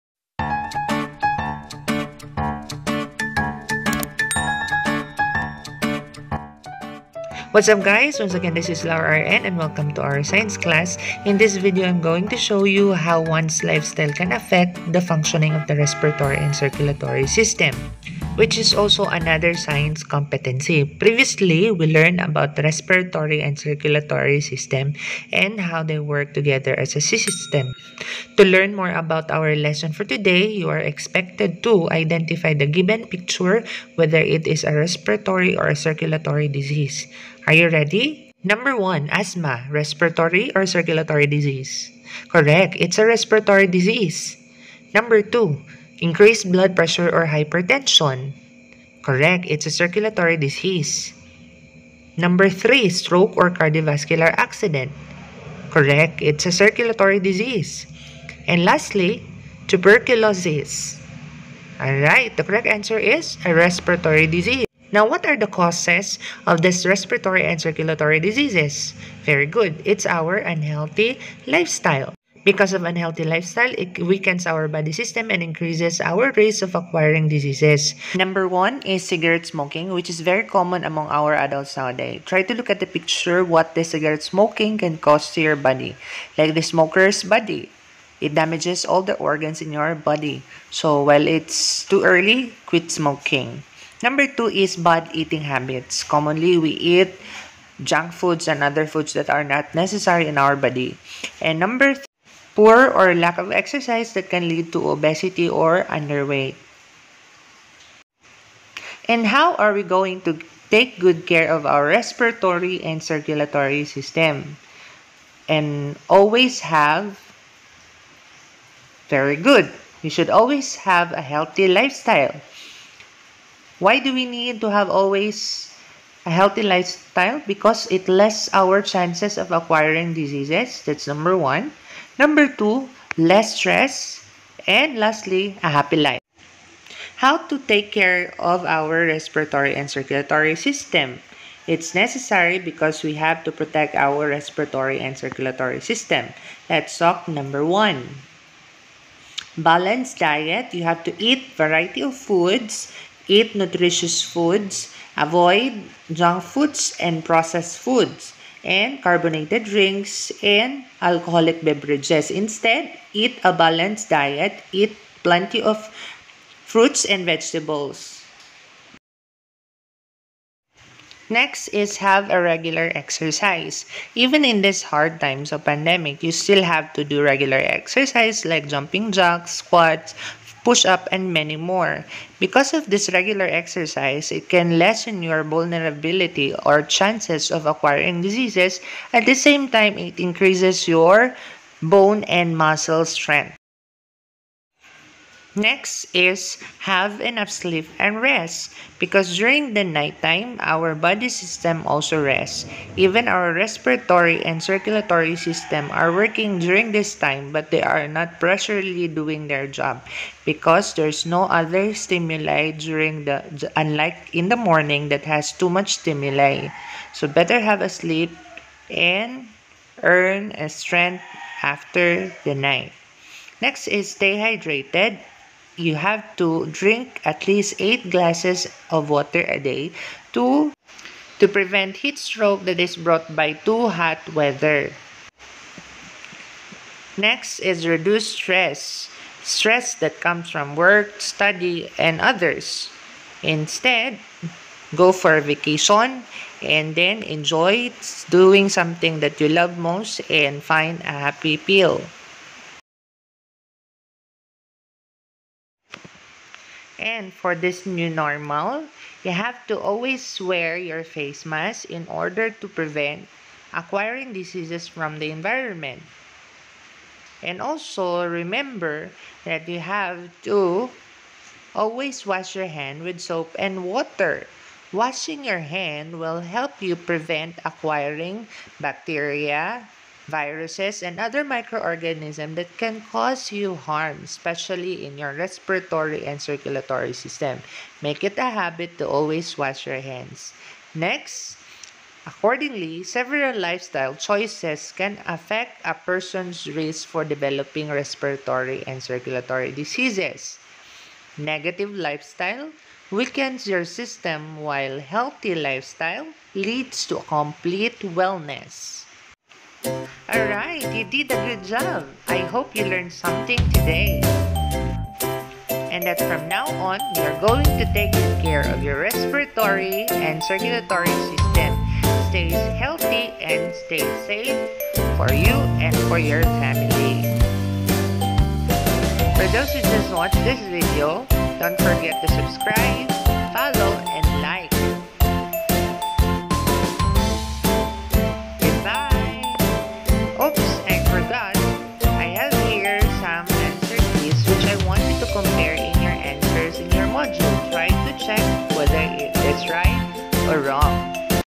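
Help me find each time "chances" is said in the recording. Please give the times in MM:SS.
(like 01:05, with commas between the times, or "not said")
02:08, 03:06.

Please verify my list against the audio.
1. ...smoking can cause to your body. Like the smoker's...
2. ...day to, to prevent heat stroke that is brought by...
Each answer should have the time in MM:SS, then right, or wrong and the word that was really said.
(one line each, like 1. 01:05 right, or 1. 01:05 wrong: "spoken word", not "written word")
1. 01:24 right
2. 03:49 right.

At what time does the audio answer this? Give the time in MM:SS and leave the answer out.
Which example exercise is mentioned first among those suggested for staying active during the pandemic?
02:58.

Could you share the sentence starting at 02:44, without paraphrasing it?
Eat plenty of fruits and vegetables.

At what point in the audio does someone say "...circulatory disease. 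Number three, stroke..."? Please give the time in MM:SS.
00:49.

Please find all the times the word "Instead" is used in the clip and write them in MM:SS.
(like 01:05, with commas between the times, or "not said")
02:42, 04:03.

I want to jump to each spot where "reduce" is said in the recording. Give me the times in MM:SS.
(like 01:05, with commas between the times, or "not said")
03:57.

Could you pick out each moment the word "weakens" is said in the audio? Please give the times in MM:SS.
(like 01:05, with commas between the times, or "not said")
01:14, 05:03.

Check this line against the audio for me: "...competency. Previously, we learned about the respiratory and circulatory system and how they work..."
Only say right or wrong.
right.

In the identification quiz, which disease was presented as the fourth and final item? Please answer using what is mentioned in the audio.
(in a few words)
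tuberculosis.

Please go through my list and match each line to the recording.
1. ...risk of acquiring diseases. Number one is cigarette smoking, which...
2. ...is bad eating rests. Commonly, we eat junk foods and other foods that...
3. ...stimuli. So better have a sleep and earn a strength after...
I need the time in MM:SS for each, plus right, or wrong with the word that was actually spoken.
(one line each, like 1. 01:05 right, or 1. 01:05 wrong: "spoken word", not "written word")
1. 01:16 right
2. 01:34 wrong: "habits", not "rests"
3. 03:35 right.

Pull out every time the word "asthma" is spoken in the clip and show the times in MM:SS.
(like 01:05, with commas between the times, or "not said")
00:39.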